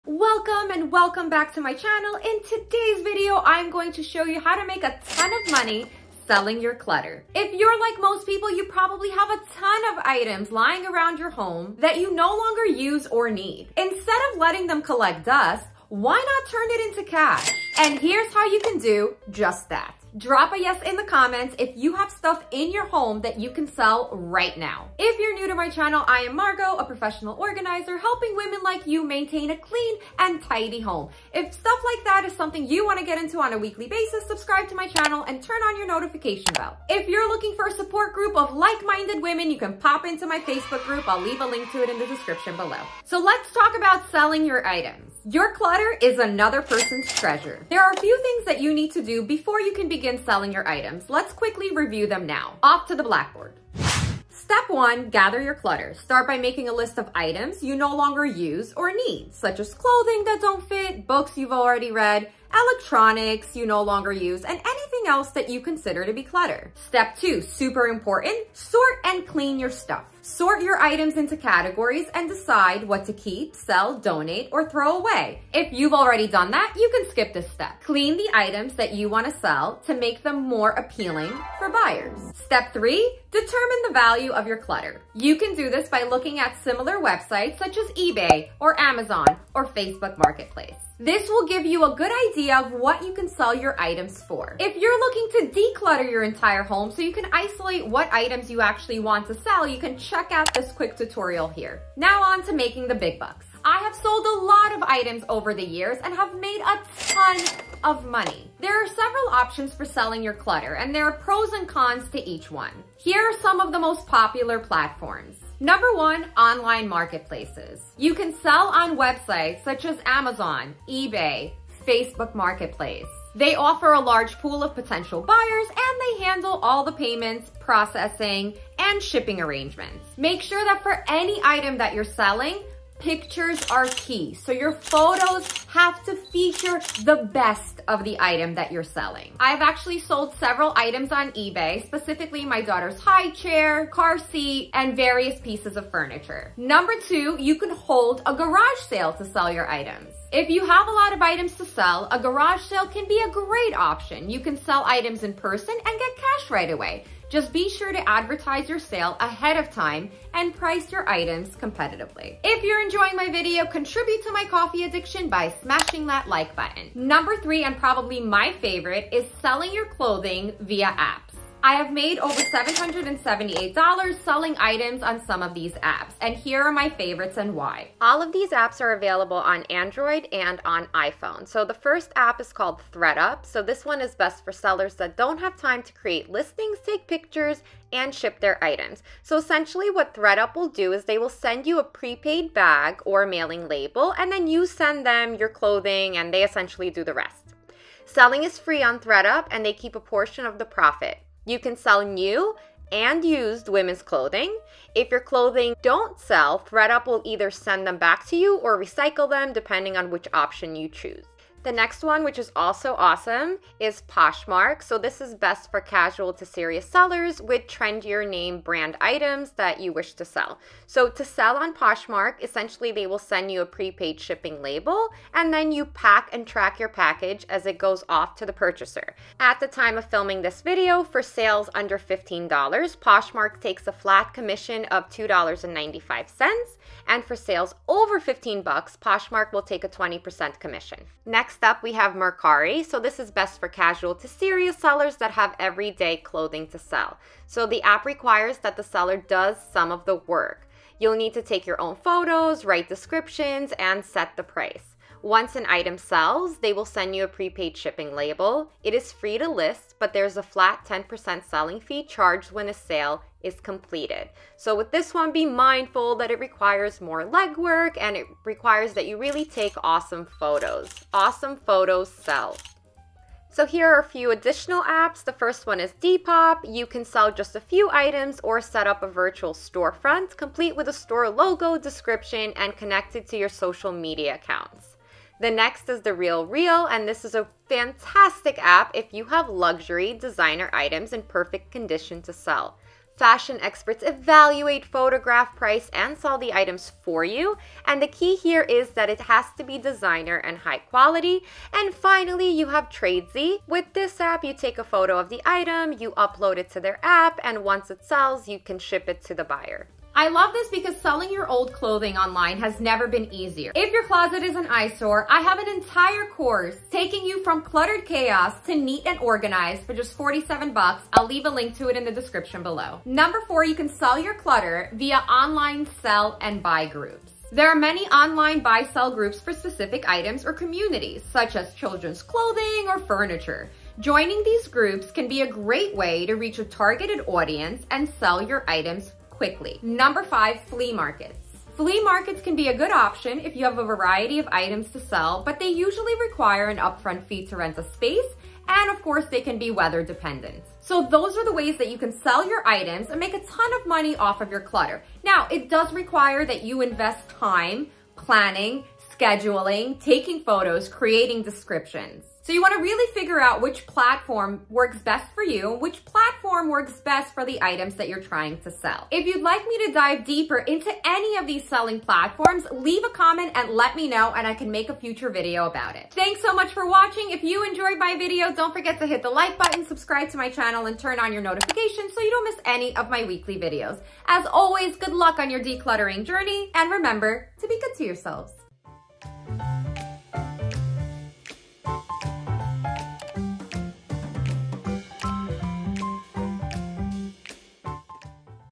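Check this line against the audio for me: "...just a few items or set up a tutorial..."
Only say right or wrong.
wrong.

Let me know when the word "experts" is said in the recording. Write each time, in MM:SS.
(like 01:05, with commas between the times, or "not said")
04:53.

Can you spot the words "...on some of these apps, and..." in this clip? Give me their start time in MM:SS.
02:55.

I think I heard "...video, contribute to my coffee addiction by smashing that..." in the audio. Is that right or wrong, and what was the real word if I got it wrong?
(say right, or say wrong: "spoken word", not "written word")
right.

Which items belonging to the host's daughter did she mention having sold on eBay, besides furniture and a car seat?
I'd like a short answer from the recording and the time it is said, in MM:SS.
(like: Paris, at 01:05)
high chair, at 02:22.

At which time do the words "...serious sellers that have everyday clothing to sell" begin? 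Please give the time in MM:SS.
04:04.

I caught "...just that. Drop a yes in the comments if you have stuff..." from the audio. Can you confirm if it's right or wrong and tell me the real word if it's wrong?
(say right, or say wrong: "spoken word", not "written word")
right.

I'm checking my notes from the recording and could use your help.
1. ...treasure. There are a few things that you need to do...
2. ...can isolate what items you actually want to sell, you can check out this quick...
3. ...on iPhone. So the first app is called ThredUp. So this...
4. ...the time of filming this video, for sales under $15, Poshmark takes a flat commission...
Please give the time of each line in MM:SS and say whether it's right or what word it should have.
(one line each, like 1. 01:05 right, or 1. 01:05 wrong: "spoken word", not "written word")
1. 00:47 right
2. 01:37 right
3. 03:00 right
4. 03:49 right.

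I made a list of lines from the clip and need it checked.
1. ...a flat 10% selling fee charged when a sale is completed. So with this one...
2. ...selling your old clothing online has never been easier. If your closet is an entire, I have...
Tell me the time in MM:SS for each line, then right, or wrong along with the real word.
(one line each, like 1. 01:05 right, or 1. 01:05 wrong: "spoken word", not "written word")
1. 04:20 right
2. 05:10 wrong: "eyesore", not "entire".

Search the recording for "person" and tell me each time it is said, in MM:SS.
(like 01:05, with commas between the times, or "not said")
00:46, 02:35.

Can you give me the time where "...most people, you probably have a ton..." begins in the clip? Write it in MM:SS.
00:08.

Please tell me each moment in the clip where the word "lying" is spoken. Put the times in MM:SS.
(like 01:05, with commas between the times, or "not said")
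00:10.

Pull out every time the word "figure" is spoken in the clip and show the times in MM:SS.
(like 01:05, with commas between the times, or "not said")
06:03.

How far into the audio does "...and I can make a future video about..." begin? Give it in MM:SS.
06:14.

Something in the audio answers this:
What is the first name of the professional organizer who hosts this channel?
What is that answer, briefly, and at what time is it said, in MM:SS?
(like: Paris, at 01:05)
Margo, at 00:26.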